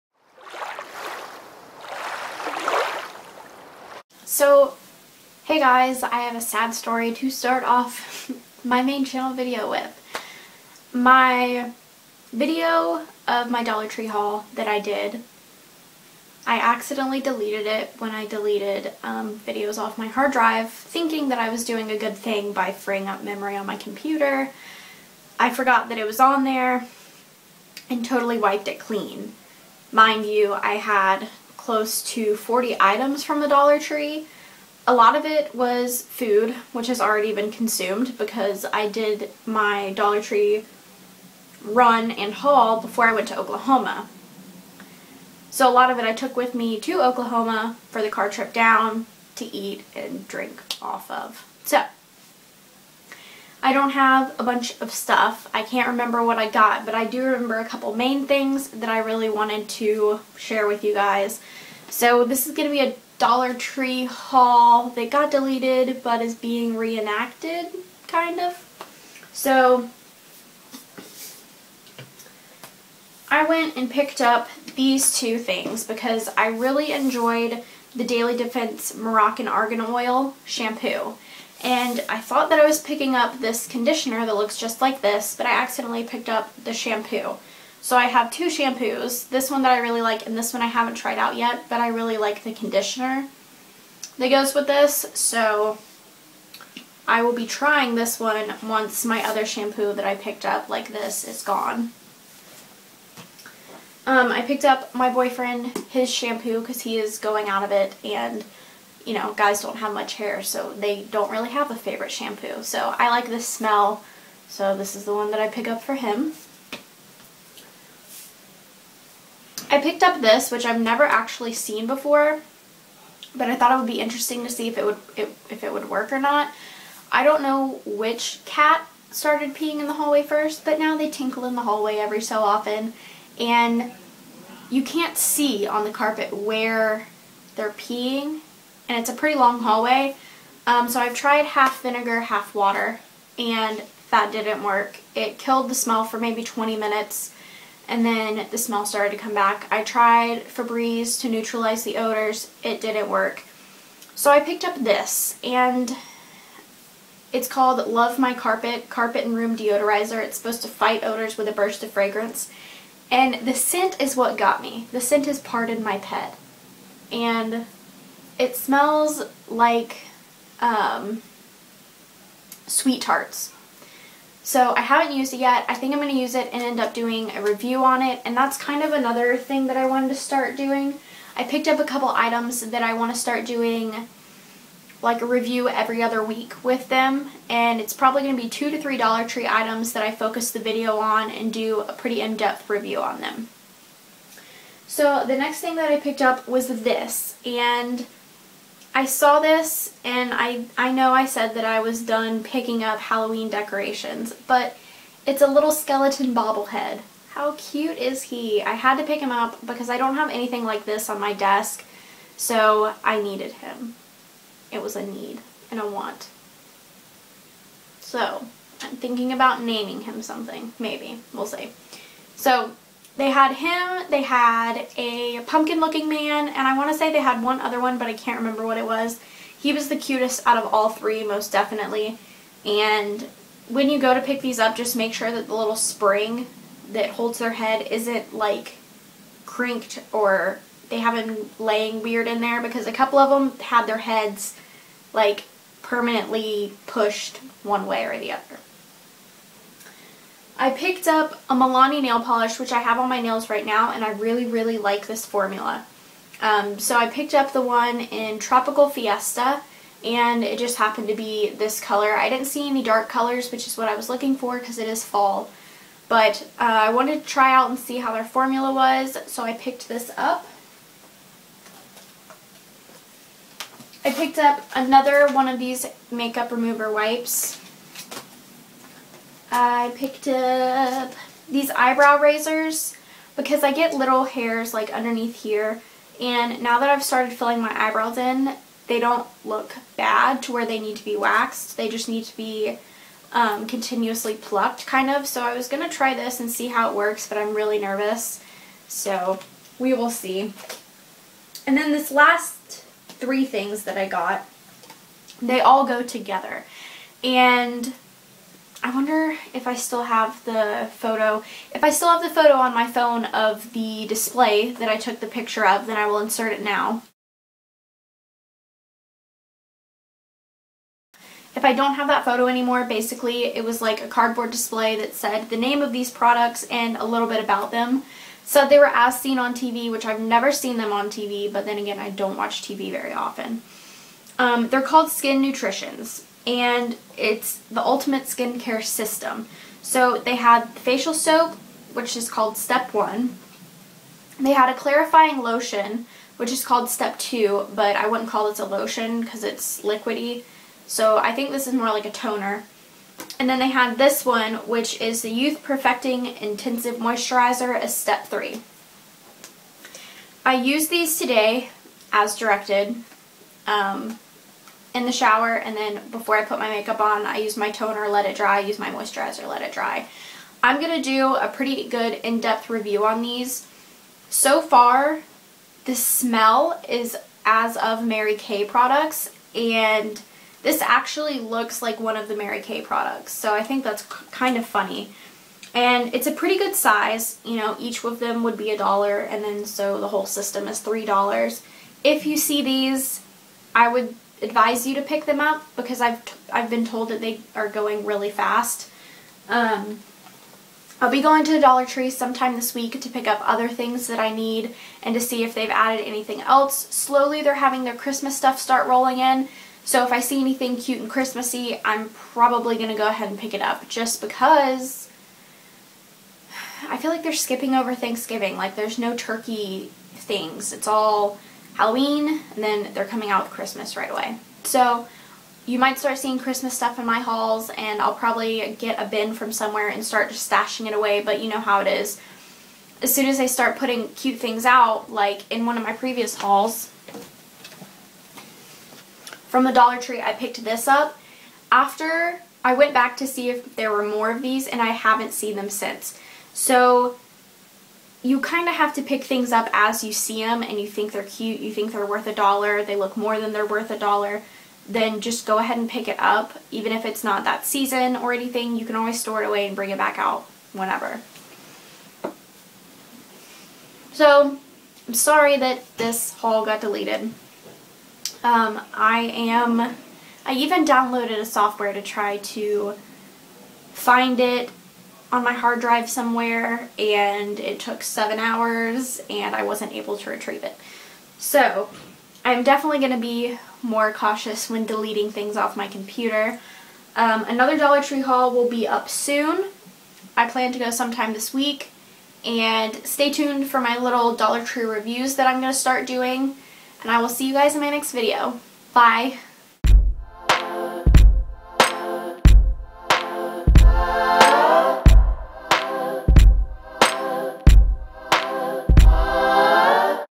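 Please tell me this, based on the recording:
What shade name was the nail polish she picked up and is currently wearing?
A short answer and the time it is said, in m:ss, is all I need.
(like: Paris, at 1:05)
Tropical Fiesta, at 4:18.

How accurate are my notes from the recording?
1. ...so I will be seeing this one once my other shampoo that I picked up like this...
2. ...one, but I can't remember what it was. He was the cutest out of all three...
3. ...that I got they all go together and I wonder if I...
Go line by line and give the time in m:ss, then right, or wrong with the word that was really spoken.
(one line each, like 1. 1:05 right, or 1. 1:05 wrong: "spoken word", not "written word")
1. 1:35 wrong: "trying", not "seeing"
2. 3:47 right
3. 5:03 right.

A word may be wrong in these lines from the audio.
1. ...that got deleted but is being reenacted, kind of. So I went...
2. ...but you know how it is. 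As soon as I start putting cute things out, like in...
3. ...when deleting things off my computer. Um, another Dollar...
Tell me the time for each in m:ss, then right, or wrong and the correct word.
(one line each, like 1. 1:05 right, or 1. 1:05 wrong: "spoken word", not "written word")
1. 1:04 right
2. 7:11 right
3. 8:04 right.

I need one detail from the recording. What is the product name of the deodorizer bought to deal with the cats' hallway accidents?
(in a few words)
Love My Carpet.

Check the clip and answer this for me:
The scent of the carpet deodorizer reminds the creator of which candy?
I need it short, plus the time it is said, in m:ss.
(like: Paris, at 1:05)
Sweet Tarts, at 2:52.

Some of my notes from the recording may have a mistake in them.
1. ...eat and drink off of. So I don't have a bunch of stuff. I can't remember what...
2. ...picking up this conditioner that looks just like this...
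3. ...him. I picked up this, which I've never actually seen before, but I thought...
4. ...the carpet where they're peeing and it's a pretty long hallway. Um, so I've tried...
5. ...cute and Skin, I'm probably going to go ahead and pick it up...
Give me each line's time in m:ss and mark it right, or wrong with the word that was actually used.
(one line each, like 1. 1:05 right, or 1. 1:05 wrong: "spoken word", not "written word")
1. 0:49 right
2. 1:22 right
3. 1:55 right
4. 2:15 right
5. 6:50 wrong: "Christmassy", not "Skin".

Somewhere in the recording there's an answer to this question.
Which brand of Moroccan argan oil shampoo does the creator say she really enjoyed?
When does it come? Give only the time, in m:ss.
1:18.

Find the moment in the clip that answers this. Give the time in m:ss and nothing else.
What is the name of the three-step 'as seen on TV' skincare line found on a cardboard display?
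5:35.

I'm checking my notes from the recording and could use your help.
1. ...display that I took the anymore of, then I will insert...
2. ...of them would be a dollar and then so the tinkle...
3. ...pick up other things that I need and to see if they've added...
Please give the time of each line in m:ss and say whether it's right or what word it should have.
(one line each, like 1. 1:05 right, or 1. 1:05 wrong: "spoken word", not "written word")
1. 5:14 wrong: "picture", not "anymore"
2. 6:28 wrong: "whole", not "tinkle"
3. 6:43 right.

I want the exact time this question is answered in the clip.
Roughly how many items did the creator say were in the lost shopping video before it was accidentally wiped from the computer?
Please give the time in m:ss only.
0:31.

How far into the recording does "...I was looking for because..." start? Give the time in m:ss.
4:23.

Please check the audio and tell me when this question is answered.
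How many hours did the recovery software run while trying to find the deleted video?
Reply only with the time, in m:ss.
7:58.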